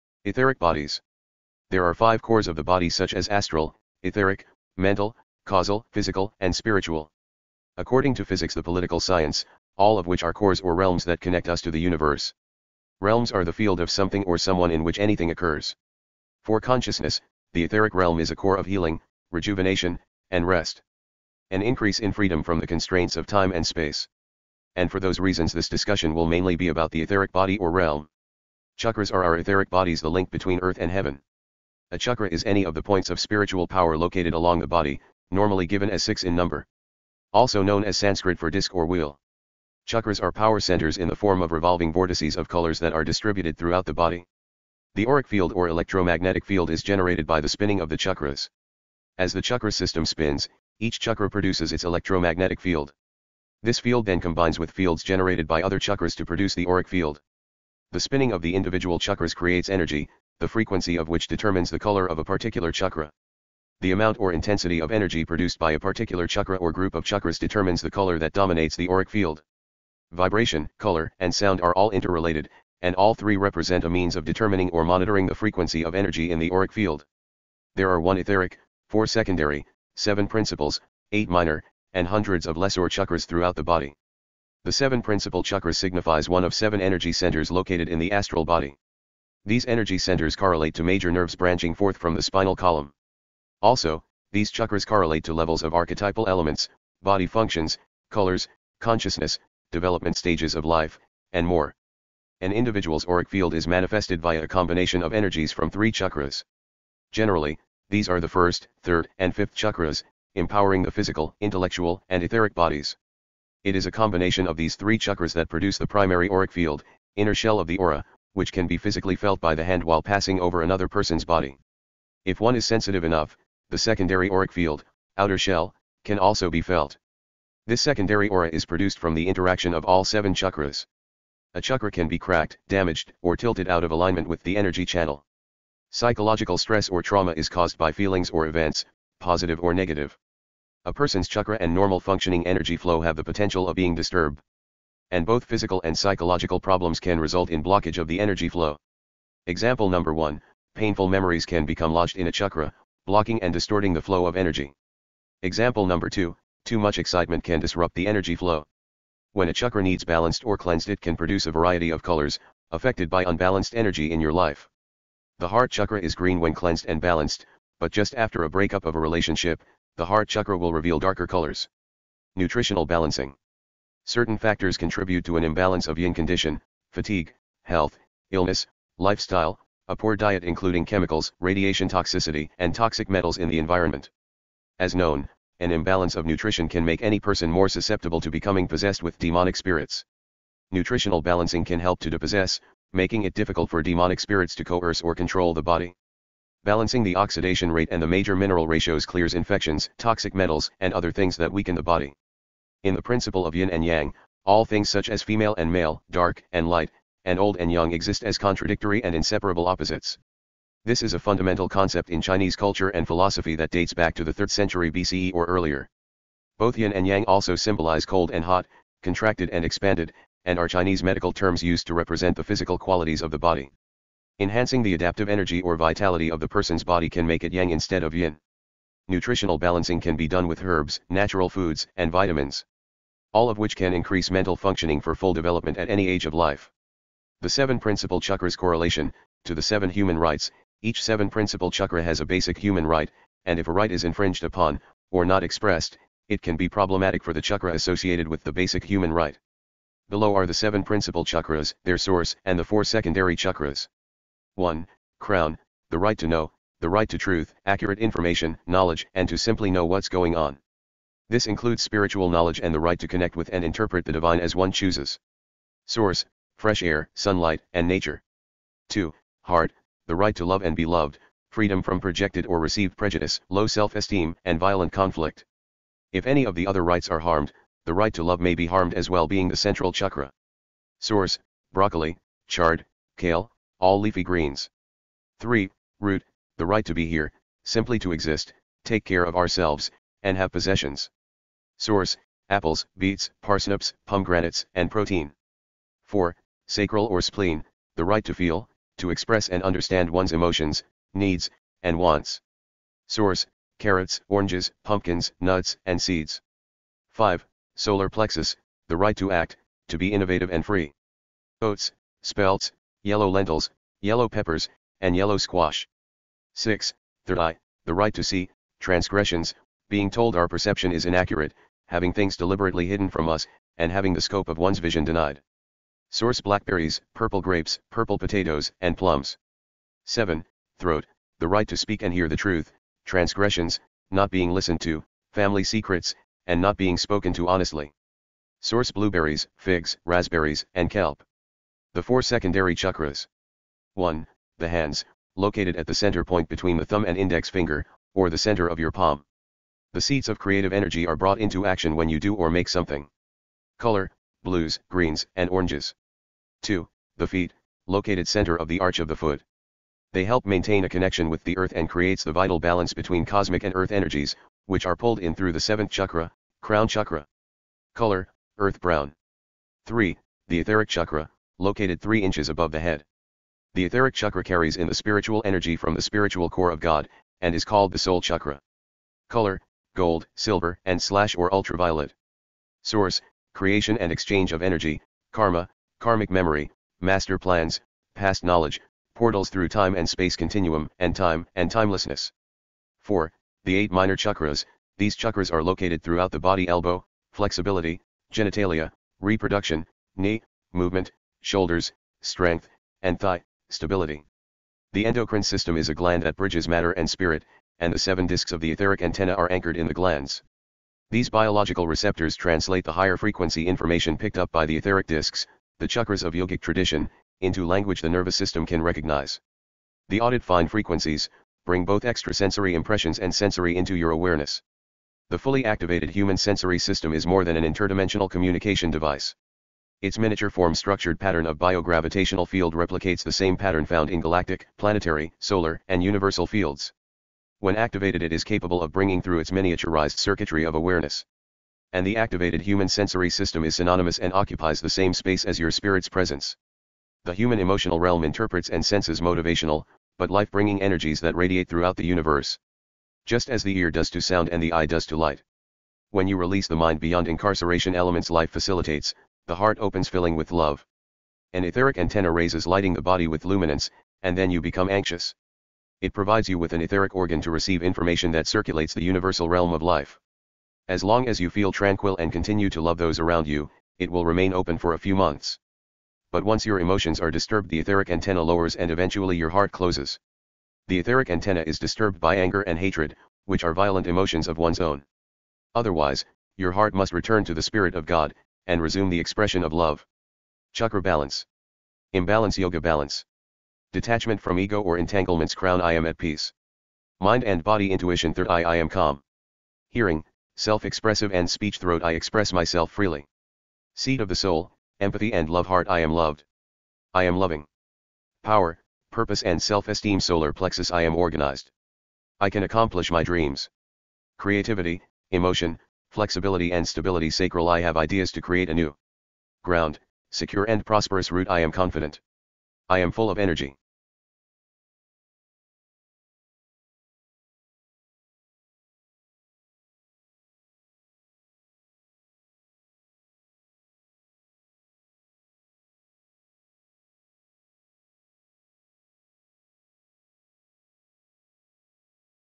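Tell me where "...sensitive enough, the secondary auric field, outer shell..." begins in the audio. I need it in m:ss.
2:02.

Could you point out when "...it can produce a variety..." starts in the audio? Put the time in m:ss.
2:40.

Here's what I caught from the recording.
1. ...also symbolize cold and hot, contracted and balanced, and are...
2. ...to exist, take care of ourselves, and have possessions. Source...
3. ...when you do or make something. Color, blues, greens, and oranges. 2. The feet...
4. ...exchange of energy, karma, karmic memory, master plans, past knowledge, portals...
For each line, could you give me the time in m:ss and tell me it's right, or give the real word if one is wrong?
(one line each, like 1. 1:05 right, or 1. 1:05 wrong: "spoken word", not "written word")
1. 3:37 wrong: "expanded", not "balanced"
2. 4:47 right
3. 5:51 right
4. 6:24 right.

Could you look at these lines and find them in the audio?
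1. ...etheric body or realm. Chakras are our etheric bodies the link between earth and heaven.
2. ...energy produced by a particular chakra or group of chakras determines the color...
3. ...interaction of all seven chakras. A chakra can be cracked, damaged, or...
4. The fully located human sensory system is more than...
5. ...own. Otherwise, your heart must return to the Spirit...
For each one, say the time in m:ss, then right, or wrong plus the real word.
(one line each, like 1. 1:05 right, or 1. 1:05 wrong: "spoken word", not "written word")
1. 0:27 right
2. 1:04 right
3. 2:09 right
4. 7:05 wrong: "activated", not "located"
5. 8:04 right.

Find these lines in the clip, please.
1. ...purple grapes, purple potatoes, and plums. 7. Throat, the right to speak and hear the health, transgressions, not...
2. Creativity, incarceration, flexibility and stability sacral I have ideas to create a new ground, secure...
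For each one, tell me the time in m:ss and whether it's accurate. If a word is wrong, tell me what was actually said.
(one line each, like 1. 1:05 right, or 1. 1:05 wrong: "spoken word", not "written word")
1. 5:27 wrong: "truth", not "health"
2. 8:34 wrong: "emotion", not "incarceration".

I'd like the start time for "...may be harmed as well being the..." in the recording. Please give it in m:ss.
4:38.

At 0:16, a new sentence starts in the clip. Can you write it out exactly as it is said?
For consciousness, the etheric realm is a core of healing, rejuvenation, and rest.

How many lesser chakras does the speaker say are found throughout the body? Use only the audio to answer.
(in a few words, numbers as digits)
hundreds.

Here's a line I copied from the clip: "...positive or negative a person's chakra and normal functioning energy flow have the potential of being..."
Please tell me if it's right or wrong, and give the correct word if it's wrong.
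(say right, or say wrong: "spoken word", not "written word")
right.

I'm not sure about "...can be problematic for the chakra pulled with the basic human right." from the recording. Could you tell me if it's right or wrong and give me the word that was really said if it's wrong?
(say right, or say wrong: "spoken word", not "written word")
wrong: "associated", not "pulled".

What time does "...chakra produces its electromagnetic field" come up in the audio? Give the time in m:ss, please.
0:50.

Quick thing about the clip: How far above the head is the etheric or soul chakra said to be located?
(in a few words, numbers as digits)
3 inches.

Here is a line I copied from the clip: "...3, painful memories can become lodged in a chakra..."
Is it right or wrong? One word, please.
wrong.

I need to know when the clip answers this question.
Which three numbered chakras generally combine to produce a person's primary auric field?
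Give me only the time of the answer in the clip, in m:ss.
1:48.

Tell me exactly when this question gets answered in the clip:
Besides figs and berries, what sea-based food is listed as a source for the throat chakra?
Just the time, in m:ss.
5:40.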